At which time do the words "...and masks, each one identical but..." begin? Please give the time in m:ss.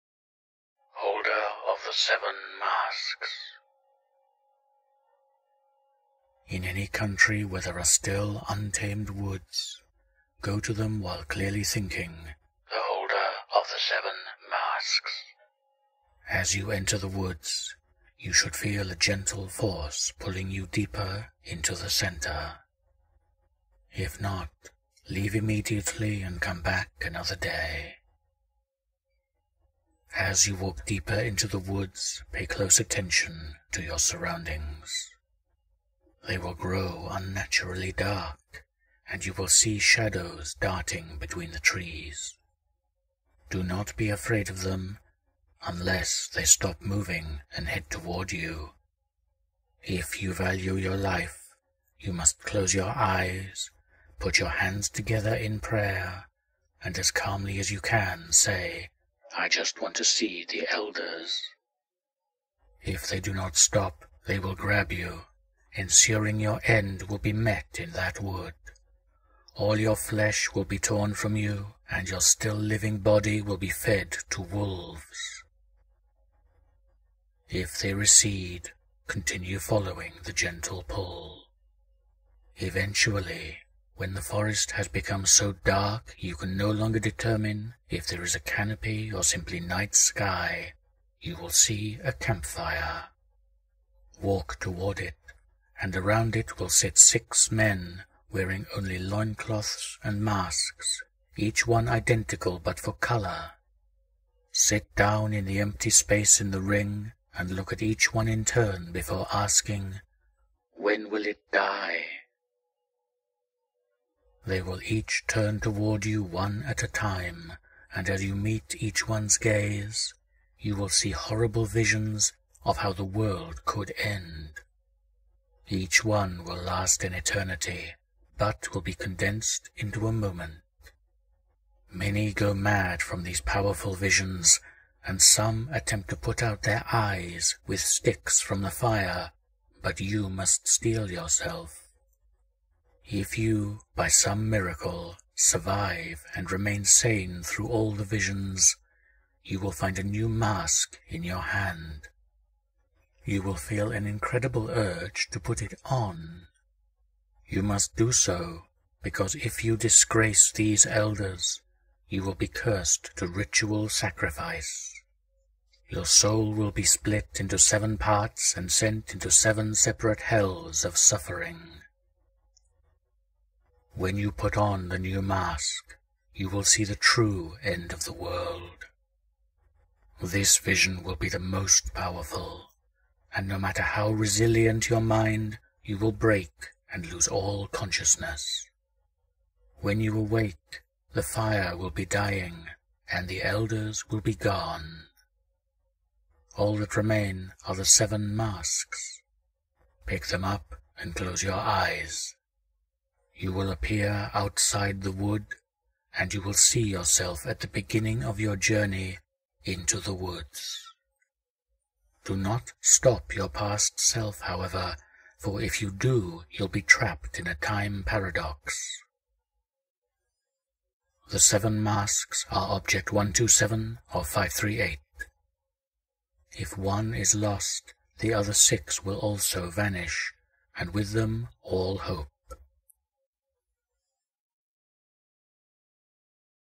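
1:40.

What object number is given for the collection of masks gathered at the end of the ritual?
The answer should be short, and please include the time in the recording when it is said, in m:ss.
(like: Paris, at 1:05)
538, at 3:44.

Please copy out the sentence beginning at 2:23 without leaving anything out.
If you, by some miracle, survive and remain sane through all the visions, you will find a new mask in your hand.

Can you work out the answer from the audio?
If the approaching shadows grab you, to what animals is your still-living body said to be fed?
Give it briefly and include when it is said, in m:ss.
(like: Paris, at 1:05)
wolves, at 1:14.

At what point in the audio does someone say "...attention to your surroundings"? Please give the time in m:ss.
0:32.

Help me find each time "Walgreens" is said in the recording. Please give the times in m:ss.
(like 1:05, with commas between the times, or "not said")
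not said.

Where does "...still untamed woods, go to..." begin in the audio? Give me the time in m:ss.
0:07.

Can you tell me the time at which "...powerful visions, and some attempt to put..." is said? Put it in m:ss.
2:13.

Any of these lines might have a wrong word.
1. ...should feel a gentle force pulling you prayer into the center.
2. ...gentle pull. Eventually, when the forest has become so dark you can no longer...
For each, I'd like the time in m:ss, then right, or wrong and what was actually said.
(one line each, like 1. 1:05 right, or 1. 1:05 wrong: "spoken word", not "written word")
1. 0:18 wrong: "deeper", not "prayer"
2. 1:20 right.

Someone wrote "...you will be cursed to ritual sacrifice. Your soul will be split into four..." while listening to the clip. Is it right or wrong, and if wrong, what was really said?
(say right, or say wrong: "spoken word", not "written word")
wrong: "seven", not "four".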